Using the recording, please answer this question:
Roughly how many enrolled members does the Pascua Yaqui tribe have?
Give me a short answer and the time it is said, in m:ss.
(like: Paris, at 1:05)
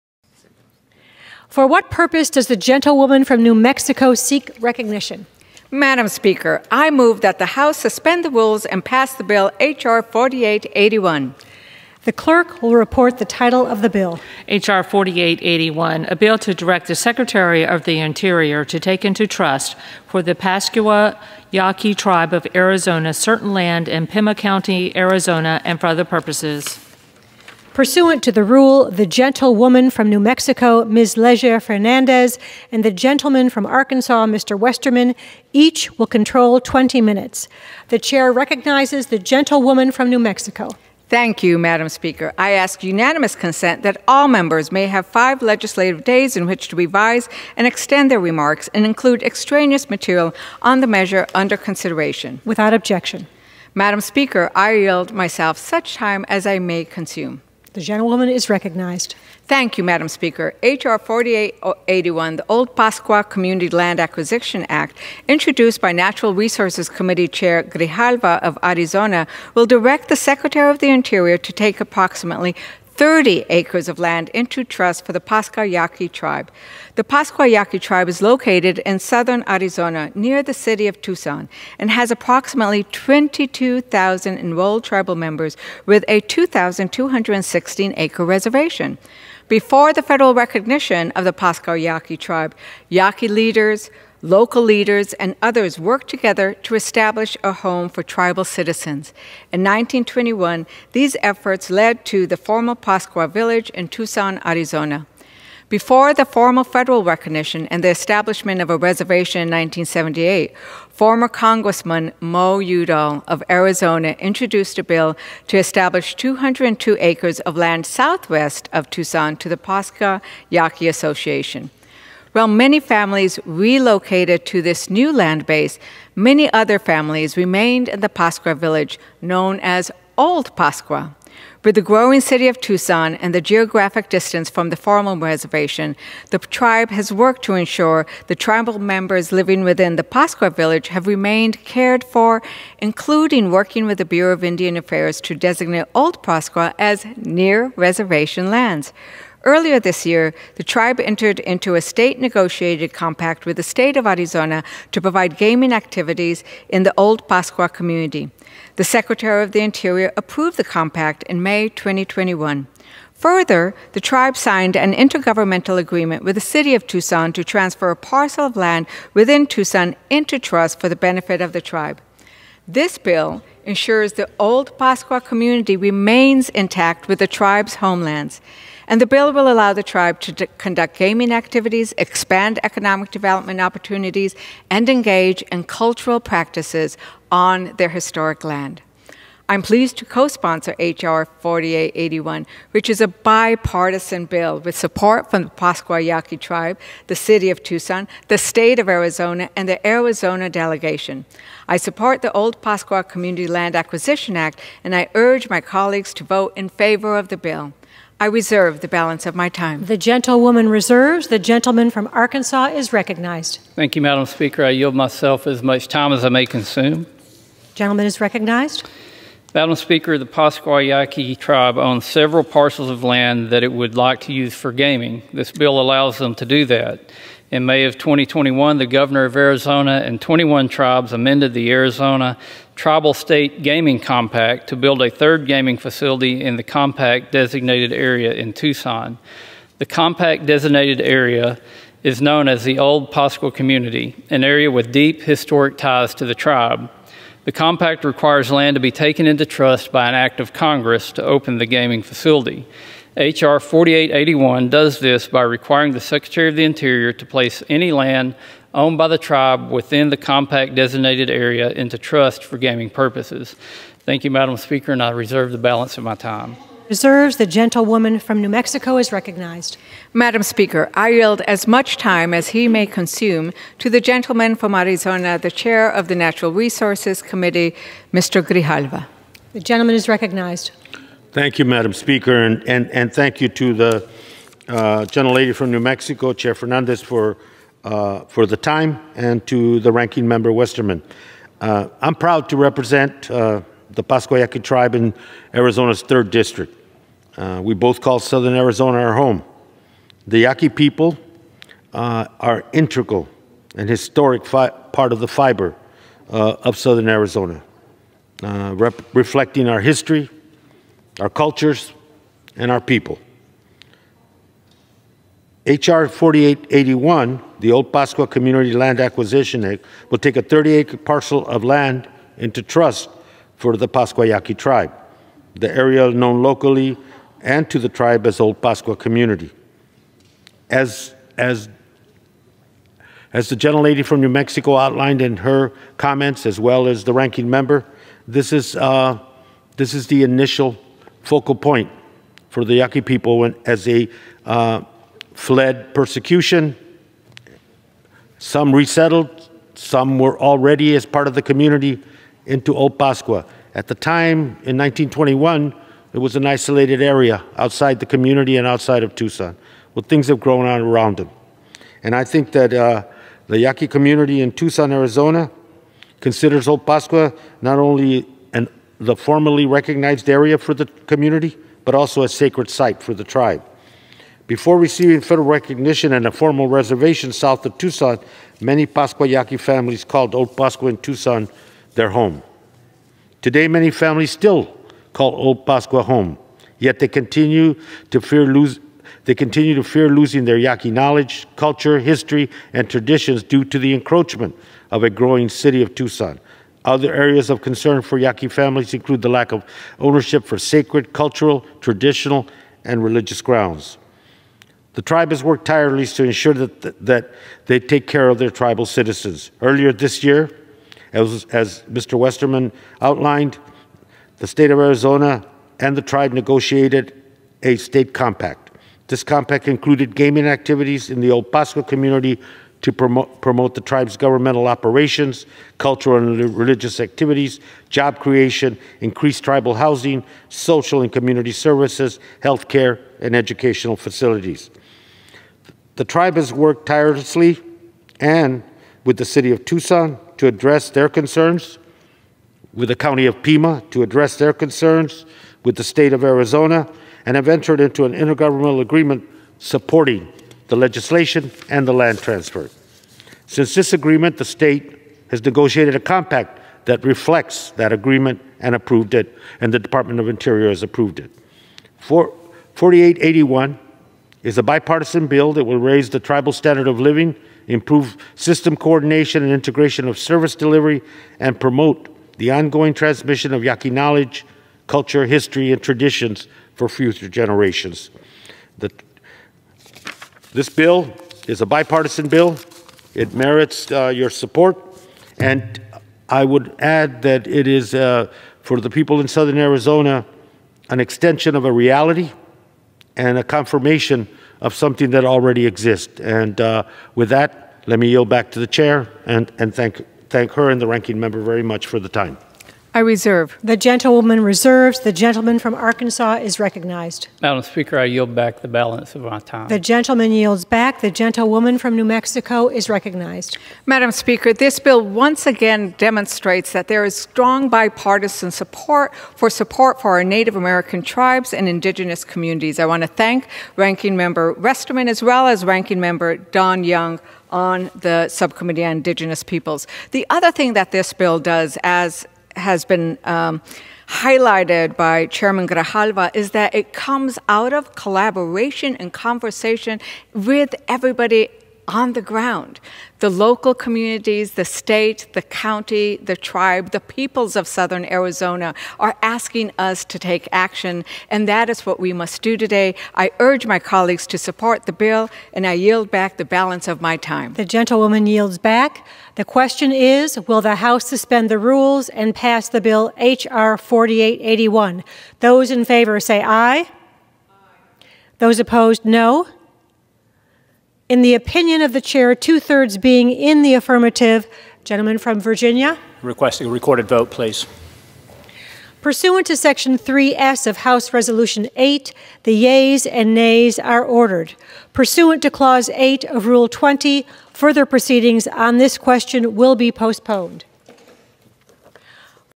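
22,000, at 1:22.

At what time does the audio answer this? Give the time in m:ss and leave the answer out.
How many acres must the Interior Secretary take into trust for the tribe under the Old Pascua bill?
1:11.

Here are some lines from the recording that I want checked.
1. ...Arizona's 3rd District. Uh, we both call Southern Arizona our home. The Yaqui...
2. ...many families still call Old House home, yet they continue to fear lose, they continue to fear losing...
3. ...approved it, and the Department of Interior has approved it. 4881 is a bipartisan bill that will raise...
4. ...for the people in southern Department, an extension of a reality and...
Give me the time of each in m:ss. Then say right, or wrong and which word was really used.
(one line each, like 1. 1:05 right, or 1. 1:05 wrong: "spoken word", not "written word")
1. 4:55 right
2. 6:23 wrong: "Pascua", not "House"
3. 7:38 right
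4. 8:08 wrong: "Arizona", not "Department".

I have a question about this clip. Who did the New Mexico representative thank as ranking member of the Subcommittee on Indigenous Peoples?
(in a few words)
Don Young.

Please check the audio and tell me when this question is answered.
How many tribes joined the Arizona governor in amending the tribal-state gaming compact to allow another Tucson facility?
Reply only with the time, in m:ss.
3:50.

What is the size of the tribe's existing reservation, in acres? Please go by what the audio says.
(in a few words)
2,216.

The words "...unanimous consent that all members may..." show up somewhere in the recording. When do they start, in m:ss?
0:42.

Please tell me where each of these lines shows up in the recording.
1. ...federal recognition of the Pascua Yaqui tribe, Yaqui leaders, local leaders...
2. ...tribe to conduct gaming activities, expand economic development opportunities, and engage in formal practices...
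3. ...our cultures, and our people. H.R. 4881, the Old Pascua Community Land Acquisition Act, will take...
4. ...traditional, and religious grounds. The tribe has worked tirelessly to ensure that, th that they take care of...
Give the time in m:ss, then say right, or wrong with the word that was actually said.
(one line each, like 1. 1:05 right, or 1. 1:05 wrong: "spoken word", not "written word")
1. 1:30 right
2. 2:59 wrong: "cultural", not "formal"
3. 5:11 right
4. 6:41 right.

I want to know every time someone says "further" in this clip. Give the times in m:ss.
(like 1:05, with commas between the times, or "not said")
2:43, 9:47.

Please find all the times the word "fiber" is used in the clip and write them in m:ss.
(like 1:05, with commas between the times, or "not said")
5:05.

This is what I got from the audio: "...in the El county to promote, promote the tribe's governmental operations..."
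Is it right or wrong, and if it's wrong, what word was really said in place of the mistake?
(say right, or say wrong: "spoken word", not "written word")
wrong: "community", not "county".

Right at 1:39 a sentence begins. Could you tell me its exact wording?
In 1921, these efforts led to the formal Pascua Village in Tucson, Arizona.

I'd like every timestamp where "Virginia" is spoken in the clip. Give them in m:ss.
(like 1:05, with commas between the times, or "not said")
9:35.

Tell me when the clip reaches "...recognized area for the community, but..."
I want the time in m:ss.
6:09.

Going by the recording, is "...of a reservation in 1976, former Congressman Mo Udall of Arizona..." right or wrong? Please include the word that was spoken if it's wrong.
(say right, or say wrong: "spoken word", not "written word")
wrong: "1978", not "1976".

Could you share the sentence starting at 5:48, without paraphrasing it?
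Some resettled, some were already as part of the community into Old Pascua.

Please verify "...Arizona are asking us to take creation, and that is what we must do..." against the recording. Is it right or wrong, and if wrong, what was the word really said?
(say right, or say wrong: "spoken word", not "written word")
wrong: "action", not "creation".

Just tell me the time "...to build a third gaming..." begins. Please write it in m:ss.
3:54.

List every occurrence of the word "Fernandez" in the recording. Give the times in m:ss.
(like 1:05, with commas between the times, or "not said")
0:31, 4:46.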